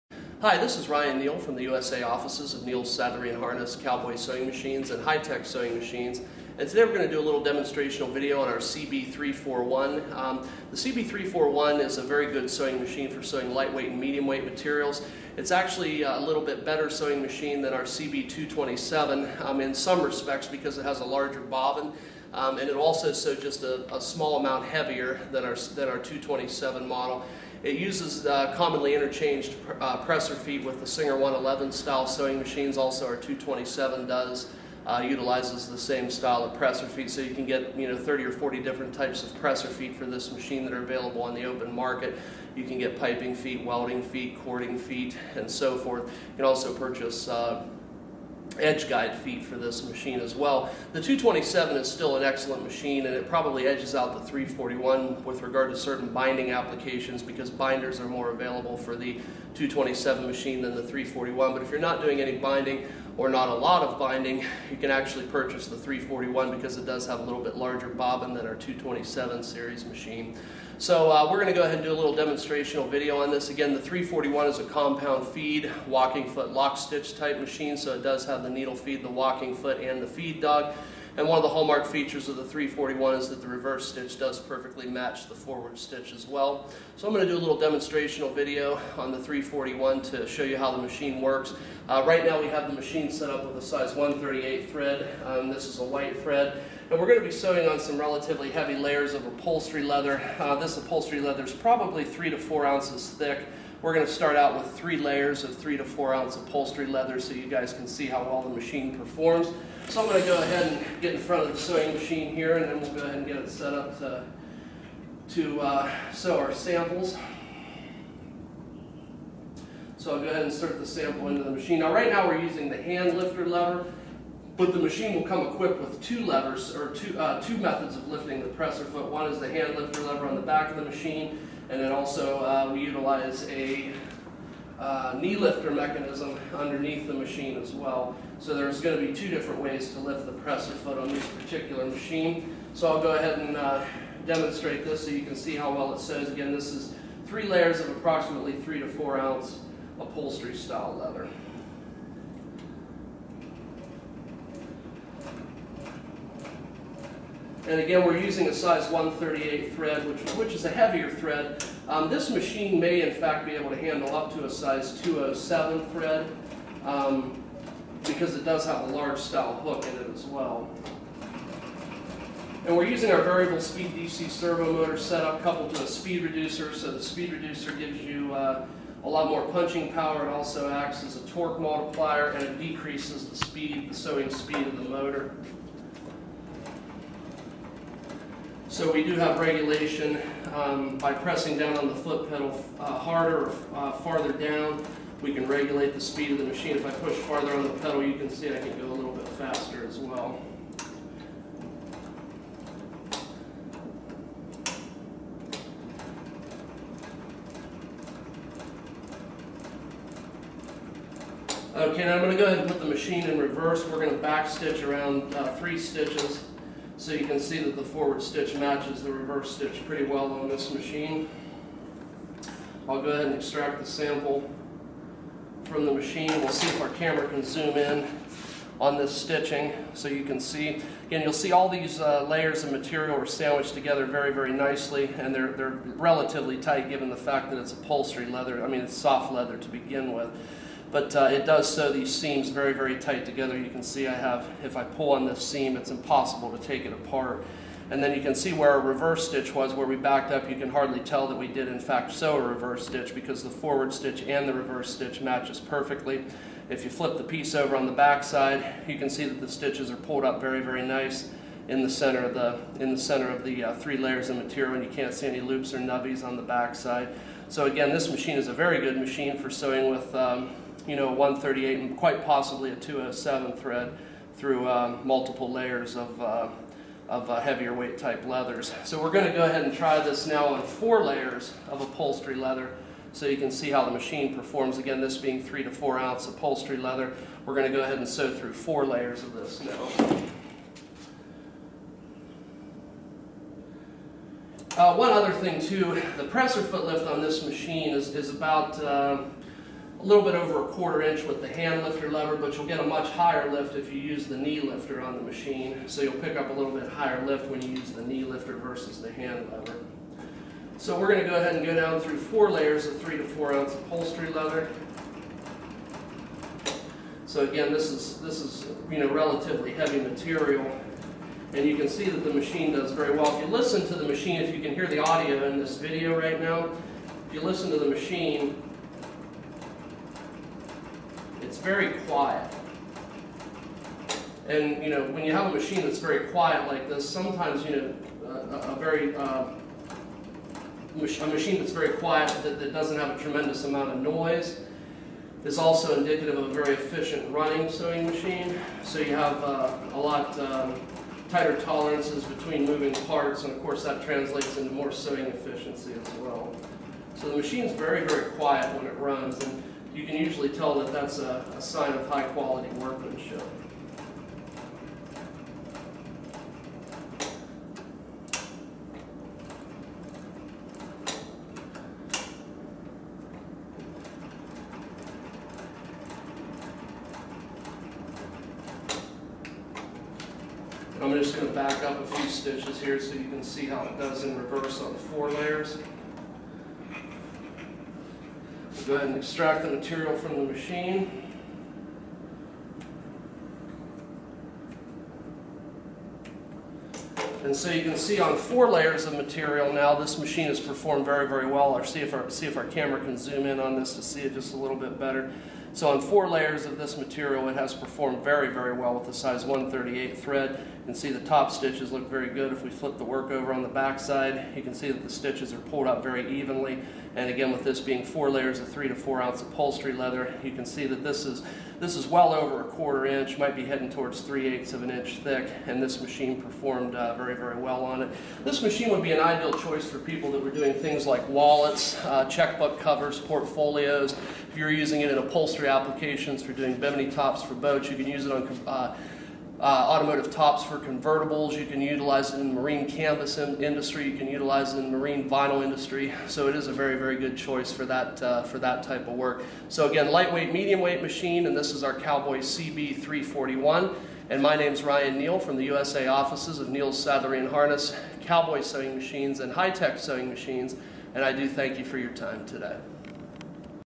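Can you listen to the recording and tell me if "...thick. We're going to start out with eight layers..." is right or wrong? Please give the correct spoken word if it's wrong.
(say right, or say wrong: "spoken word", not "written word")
wrong: "three", not "eight".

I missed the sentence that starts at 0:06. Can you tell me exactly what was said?
And today we're going to do a little demonstrational video on our CB341.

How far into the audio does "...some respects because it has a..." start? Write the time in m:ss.
0:19.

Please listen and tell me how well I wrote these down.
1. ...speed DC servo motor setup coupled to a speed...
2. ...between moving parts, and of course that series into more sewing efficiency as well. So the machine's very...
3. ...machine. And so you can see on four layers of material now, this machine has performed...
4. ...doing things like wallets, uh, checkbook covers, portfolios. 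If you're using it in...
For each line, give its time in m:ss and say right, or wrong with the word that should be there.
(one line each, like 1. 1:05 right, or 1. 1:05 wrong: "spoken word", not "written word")
1. 2:53 right
2. 5:52 wrong: "translates", not "series"
3. 6:30 right
4. 7:10 right.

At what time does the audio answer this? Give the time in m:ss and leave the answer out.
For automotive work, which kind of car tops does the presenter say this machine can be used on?
7:20.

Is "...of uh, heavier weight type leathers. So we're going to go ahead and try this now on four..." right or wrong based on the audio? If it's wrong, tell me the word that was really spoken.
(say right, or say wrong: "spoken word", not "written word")
right.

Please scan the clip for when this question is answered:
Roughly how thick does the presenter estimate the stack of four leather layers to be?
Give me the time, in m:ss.
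7:04.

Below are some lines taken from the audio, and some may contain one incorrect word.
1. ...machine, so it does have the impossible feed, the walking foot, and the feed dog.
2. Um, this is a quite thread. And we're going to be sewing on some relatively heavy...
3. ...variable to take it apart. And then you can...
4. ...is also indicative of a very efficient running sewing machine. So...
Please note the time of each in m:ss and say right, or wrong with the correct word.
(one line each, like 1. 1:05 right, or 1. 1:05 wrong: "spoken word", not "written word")
1. 1:17 wrong: "needle", not "impossible"
2. 1:35 wrong: "white", not "quite"
3. 4:05 wrong: "impossible", not "variable"
4. 5:45 right.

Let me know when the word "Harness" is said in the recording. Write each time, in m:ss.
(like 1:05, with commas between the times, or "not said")
0:03, 7:37.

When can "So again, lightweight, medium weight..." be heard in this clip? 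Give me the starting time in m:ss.
7:29.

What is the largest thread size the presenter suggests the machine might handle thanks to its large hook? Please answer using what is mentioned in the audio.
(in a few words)
207.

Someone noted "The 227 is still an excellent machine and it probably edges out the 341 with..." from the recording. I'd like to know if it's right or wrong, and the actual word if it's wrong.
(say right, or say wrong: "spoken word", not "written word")
right.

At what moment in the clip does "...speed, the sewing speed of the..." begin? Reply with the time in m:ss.
3:03.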